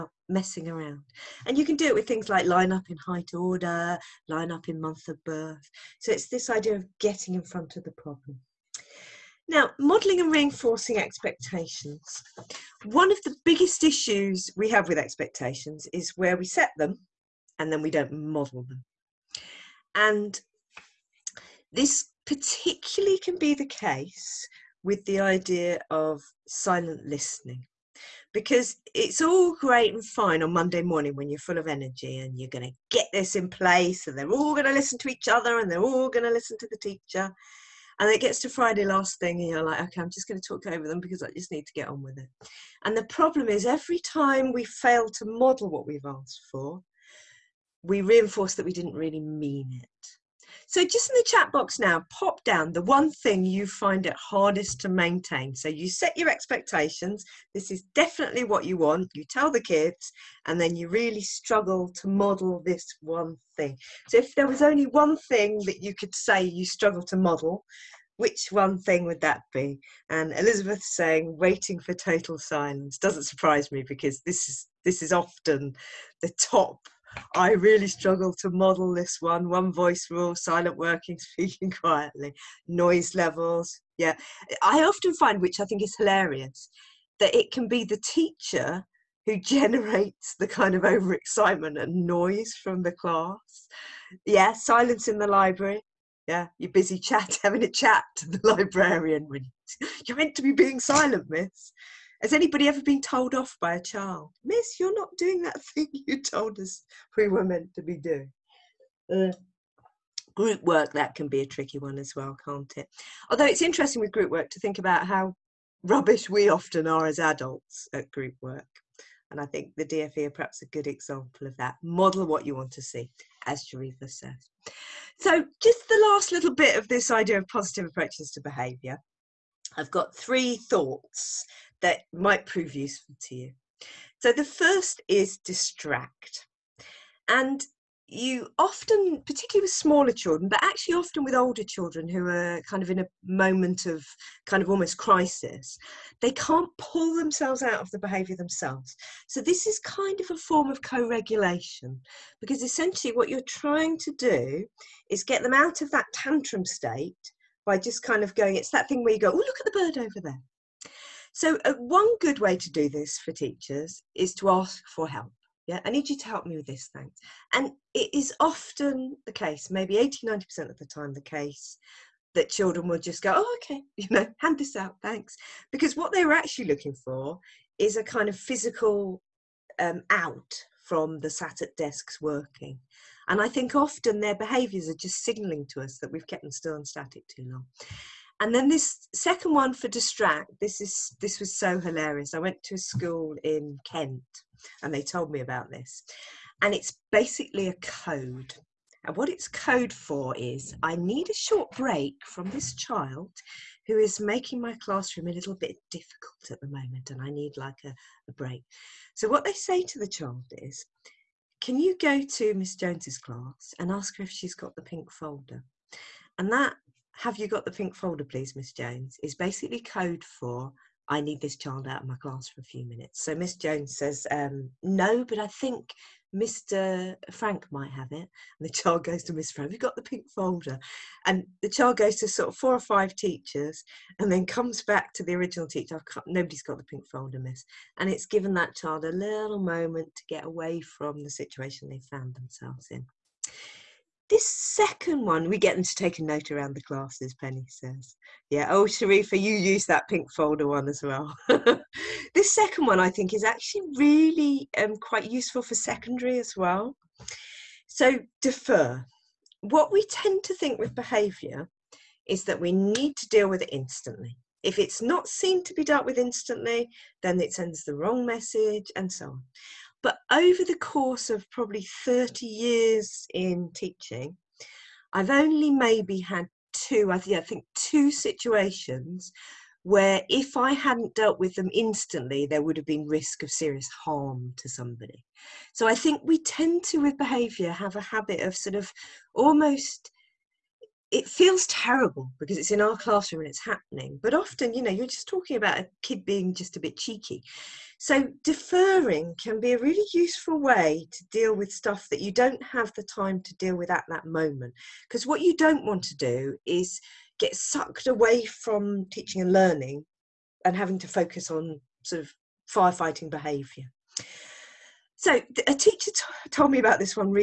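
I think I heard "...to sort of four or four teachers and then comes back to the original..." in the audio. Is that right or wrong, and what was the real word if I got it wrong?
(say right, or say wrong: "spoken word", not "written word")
wrong: "five", not "four".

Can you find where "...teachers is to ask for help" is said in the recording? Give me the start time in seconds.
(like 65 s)
163 s.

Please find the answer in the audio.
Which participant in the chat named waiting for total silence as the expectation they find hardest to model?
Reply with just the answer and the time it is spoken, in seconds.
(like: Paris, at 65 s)
Elizabeth, at 70 s.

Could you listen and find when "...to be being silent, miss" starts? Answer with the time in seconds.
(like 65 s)
100 s.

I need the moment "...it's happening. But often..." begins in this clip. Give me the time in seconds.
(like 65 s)
293 s.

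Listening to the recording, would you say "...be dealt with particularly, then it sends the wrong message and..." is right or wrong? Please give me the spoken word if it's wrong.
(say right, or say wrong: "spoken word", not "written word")
wrong: "instantly", not "particularly".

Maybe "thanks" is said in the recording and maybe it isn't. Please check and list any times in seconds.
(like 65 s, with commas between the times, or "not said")
166 s, 175 s.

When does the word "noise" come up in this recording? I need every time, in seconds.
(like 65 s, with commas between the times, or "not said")
82 s, 92 s.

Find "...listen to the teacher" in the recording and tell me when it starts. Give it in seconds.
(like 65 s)
36 s.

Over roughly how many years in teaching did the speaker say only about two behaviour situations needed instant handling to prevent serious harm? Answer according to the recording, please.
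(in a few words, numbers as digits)
30.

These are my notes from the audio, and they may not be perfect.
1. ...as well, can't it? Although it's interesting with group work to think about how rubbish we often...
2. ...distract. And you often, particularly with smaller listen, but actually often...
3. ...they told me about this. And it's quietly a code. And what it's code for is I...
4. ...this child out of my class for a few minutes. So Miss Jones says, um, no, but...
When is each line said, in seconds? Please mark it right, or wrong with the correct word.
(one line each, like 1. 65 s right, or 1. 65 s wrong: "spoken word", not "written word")
1. 111 s right
2. 135 s wrong: "children", not "listen"
3. 194 s wrong: "basically", not "quietly"
4. 221 s right.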